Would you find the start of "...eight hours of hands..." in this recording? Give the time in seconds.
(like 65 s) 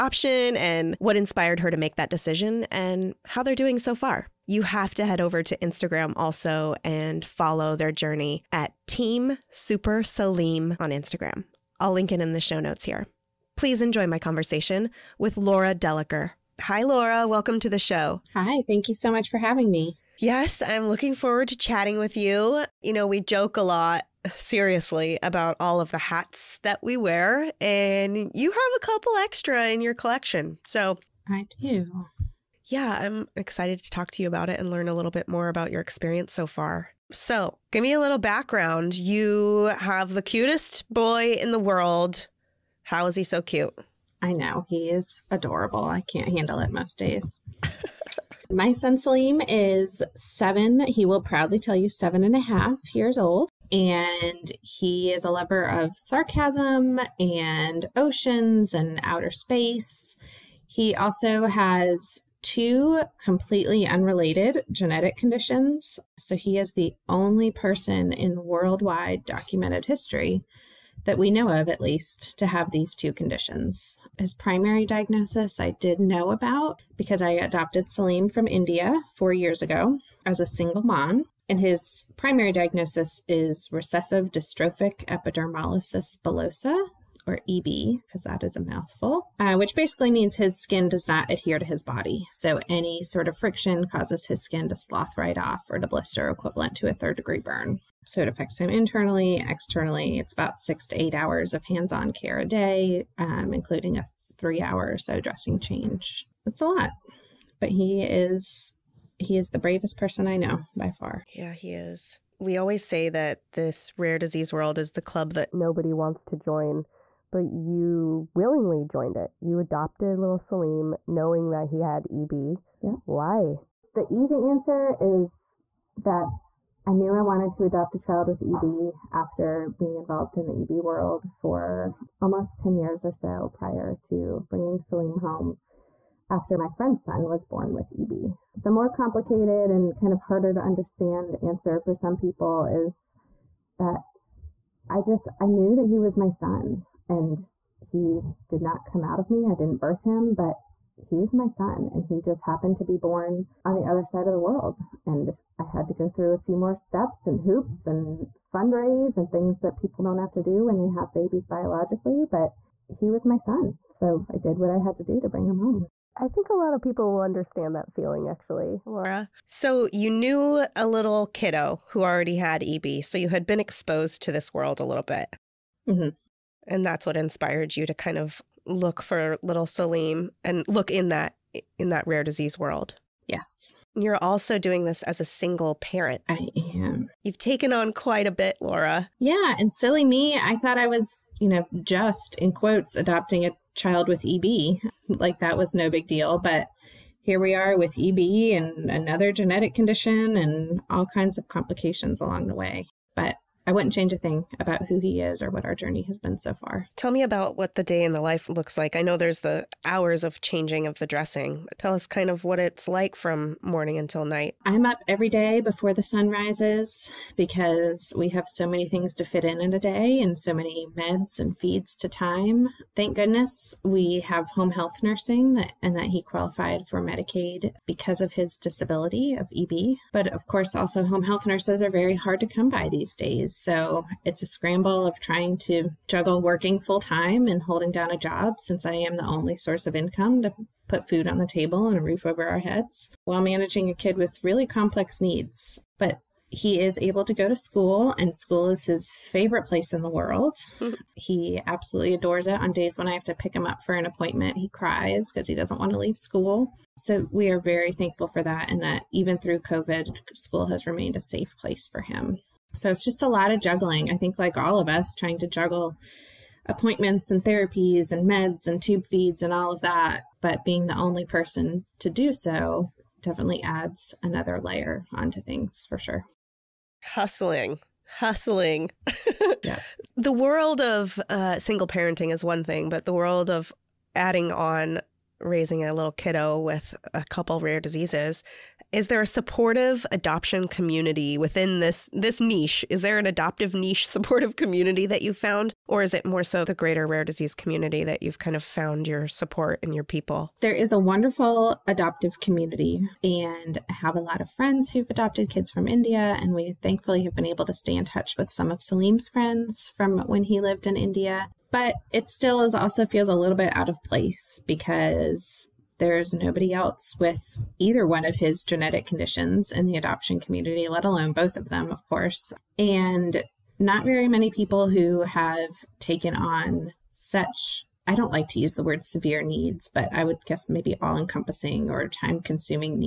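101 s.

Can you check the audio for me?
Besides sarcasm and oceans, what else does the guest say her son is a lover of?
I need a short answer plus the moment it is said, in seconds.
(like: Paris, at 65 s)
outer space, at 59 s.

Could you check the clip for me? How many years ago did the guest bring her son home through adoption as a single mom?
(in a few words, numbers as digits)
4.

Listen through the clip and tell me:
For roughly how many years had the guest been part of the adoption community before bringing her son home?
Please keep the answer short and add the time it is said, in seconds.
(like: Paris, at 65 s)
10, at 132 s.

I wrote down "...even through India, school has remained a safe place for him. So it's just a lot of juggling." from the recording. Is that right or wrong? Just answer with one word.
wrong.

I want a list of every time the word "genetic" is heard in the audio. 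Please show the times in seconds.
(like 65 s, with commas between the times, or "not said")
64 s, 199 s, 318 s.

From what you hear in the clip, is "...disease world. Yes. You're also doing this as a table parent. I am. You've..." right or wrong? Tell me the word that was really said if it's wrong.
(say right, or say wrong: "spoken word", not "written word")
wrong: "single", not "table".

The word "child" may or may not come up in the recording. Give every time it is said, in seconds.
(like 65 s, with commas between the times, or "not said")
127 s, 193 s.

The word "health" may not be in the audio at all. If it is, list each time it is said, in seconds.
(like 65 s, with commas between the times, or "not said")
224 s, 231 s.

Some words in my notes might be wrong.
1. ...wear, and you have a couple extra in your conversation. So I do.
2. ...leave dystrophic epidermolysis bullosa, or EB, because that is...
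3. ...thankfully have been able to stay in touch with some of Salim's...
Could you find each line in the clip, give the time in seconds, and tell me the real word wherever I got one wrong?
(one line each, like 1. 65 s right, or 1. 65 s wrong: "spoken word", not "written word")
1. 26 s wrong: "collection", not "conversation"
2. 83 s wrong: "recessive", not "leave"
3. 306 s right.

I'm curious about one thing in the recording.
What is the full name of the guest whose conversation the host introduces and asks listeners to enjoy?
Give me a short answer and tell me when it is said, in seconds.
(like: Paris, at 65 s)
Laura Dellicker, at 15 s.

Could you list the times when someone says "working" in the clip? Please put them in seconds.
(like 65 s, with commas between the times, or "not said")
236 s.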